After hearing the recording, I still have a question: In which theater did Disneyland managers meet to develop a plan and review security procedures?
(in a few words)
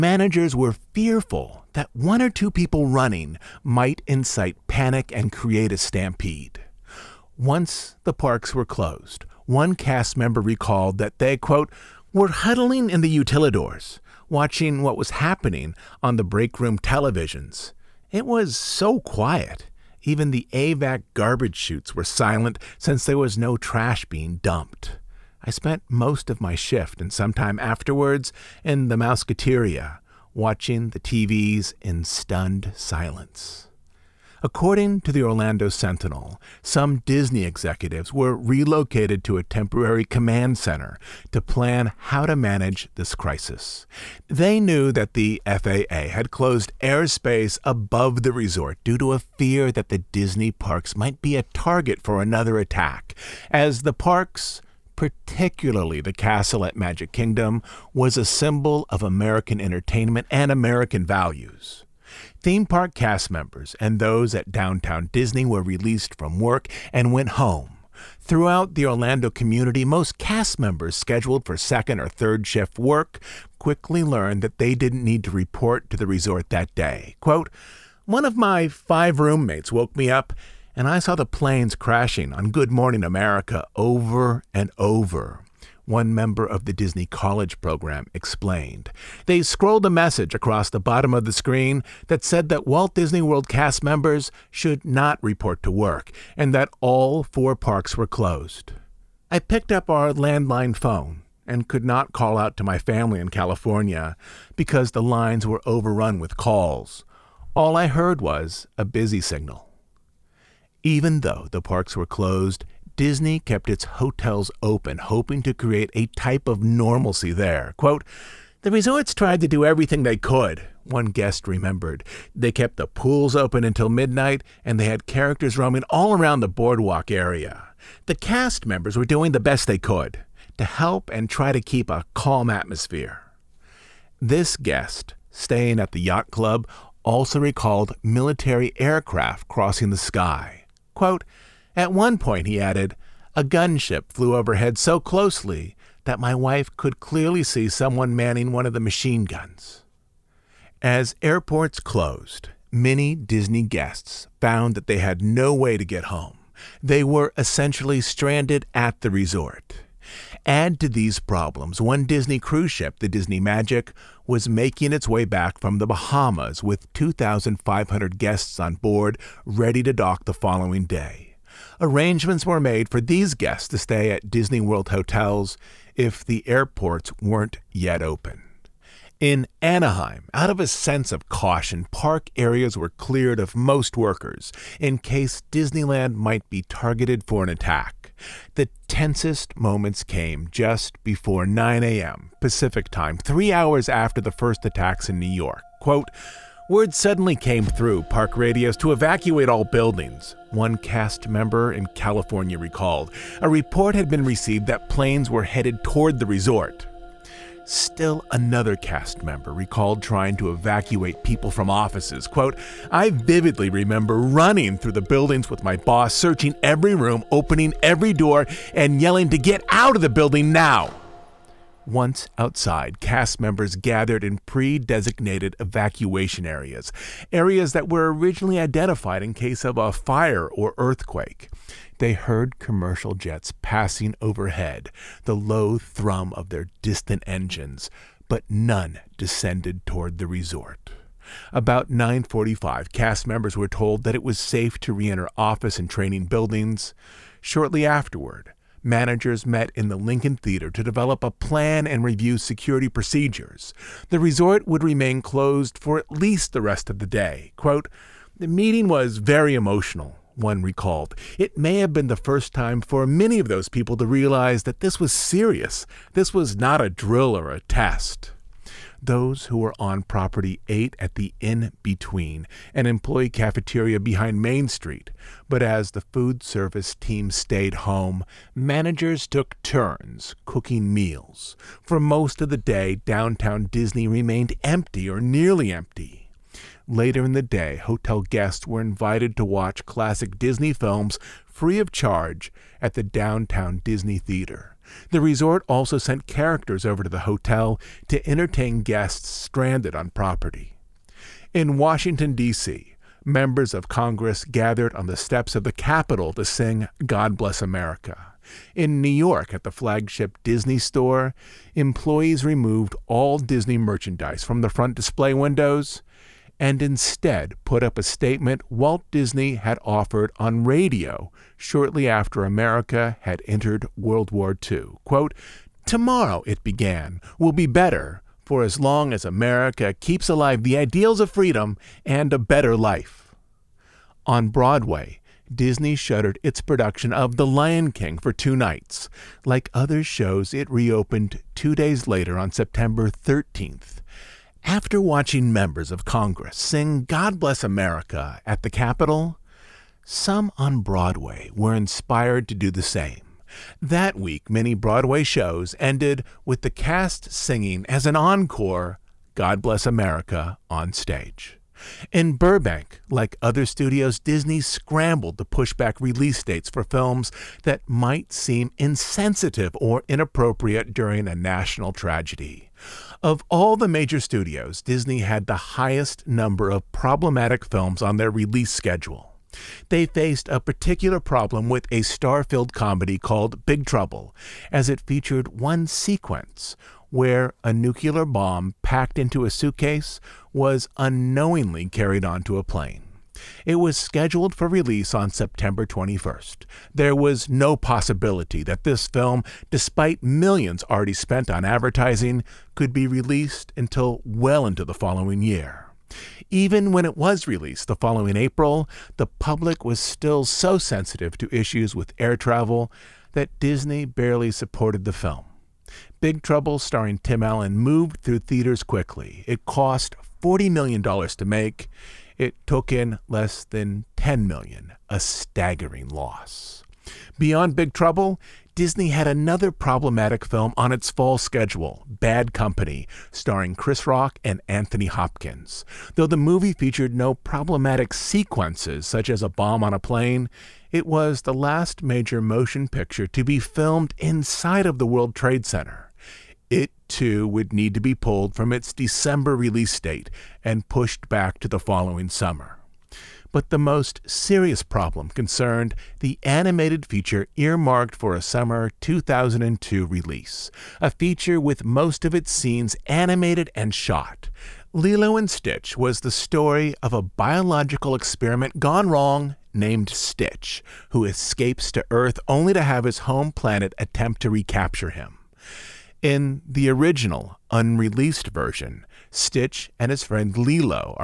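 Lincoln Theater.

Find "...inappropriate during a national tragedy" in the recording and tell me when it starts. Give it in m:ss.
6:10.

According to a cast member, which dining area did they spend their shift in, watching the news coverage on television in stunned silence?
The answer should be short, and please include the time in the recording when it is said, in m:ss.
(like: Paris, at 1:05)
Mouseketeria, at 0:28.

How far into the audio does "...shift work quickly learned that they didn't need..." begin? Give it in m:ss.
1:12.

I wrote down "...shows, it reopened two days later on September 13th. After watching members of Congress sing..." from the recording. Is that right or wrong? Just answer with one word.
right.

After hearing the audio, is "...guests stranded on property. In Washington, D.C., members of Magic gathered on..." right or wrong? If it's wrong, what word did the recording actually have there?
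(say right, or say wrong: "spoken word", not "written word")
wrong: "Congress", not "Magic".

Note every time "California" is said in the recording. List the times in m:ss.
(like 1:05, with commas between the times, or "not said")
1:43, 3:21.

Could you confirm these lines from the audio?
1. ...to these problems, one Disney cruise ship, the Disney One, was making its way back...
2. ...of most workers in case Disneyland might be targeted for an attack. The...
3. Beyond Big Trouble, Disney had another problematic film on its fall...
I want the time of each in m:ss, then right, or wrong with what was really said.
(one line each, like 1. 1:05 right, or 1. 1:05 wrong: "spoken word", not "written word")
1. 2:40 wrong: "Magic", not "One"
2. 3:03 right
3. 7:07 right.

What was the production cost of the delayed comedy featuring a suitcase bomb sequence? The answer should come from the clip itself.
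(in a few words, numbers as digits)
$40 million.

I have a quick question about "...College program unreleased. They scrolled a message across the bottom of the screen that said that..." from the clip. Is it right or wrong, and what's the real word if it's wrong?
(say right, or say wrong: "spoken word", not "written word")
wrong: "explained", not "unreleased".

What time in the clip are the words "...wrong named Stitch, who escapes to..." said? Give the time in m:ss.
7:49.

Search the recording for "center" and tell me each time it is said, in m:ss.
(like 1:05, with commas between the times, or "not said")
0:40, 7:25.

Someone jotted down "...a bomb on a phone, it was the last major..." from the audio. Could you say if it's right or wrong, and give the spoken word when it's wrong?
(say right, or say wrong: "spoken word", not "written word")
wrong: "plane", not "phone".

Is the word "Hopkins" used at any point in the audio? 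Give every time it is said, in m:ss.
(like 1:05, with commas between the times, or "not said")
7:15.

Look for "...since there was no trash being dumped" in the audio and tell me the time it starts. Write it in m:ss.
0:22.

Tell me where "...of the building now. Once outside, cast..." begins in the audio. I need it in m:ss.
3:39.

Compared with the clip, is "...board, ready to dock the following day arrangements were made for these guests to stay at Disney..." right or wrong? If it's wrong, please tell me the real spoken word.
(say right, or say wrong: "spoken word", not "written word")
right.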